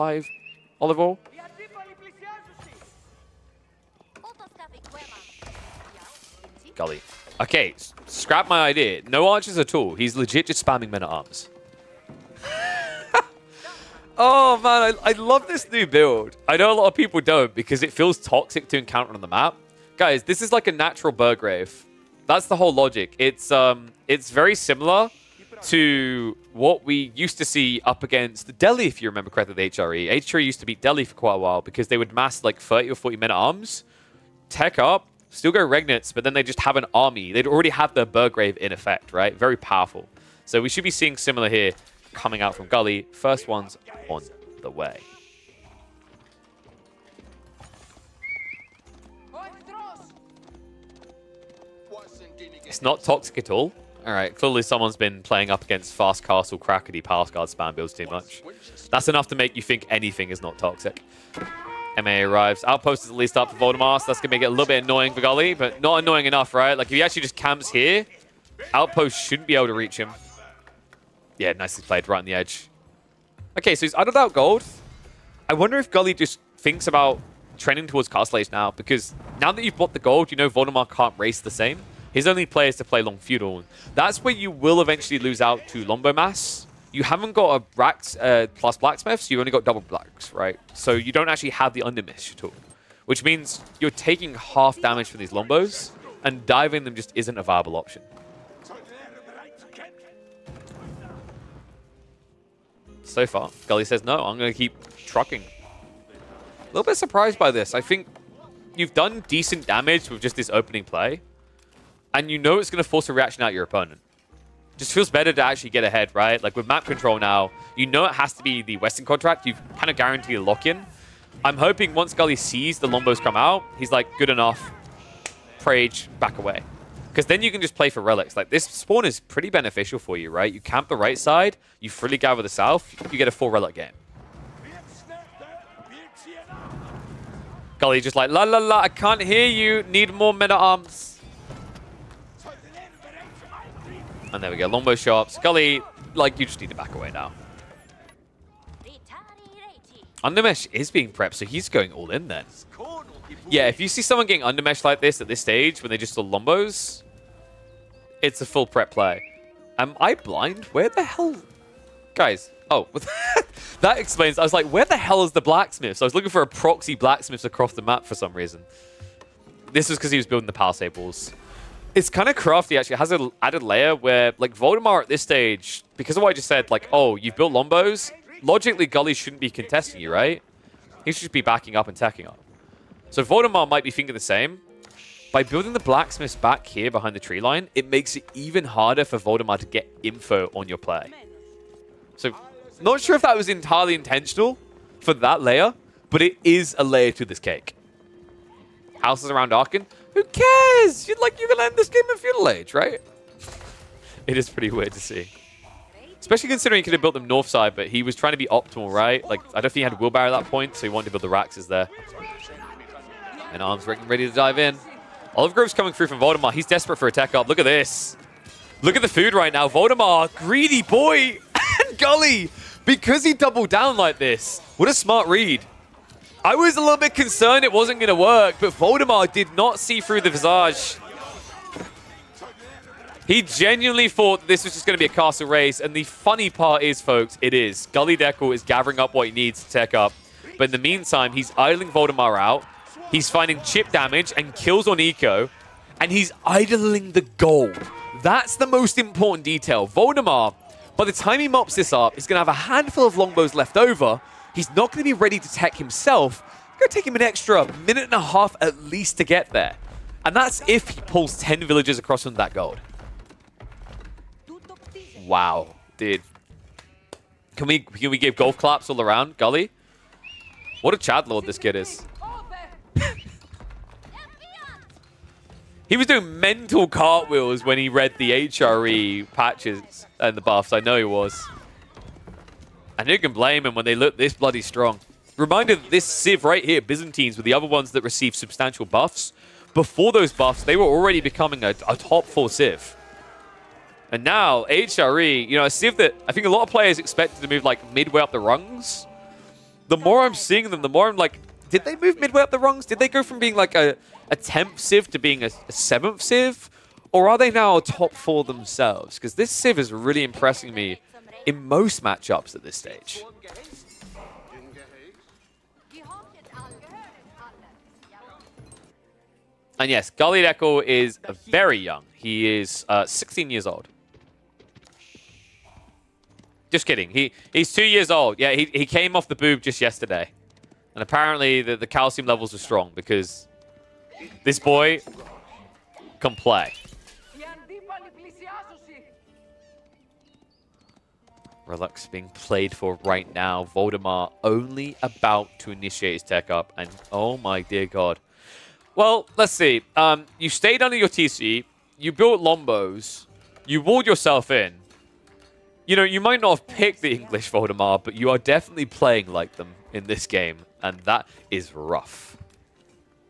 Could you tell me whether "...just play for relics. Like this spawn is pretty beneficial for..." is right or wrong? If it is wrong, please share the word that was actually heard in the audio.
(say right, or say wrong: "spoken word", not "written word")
right.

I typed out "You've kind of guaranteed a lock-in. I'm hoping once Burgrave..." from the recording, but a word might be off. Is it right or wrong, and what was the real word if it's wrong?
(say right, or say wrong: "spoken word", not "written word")
wrong: "Gully", not "Burgrave".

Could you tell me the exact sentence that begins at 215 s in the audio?
Olive Grove's coming through from Voldemar.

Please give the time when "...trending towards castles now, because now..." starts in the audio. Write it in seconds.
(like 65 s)
77 s.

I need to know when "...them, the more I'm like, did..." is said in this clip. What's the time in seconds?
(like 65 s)
300 s.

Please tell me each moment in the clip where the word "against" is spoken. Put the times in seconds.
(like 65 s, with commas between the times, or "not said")
28 s, 55 s.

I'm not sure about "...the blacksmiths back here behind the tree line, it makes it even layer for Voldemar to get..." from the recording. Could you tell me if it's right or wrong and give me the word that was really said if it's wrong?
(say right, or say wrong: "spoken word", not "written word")
wrong: "harder", not "layer".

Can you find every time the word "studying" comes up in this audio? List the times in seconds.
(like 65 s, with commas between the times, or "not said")
not said.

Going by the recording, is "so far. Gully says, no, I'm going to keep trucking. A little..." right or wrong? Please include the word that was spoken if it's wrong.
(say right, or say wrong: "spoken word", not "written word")
right.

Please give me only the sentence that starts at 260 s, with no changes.
And that's if he pulls 10 villagers across from that gold.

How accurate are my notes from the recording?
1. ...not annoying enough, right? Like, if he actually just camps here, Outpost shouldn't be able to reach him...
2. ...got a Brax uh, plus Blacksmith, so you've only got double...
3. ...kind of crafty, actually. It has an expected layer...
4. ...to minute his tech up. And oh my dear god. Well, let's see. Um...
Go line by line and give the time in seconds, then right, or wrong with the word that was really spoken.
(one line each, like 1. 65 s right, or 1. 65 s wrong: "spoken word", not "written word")
1. 65 s right
2. 87 s right
3. 172 s wrong: "added", not "expected"
4. 345 s wrong: "initiate", not "minute".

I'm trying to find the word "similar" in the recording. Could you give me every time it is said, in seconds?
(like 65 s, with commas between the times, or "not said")
24 s, 41 s.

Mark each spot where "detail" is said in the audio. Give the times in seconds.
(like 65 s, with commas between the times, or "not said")
249 s.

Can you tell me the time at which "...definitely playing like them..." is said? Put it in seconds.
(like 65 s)
358 s.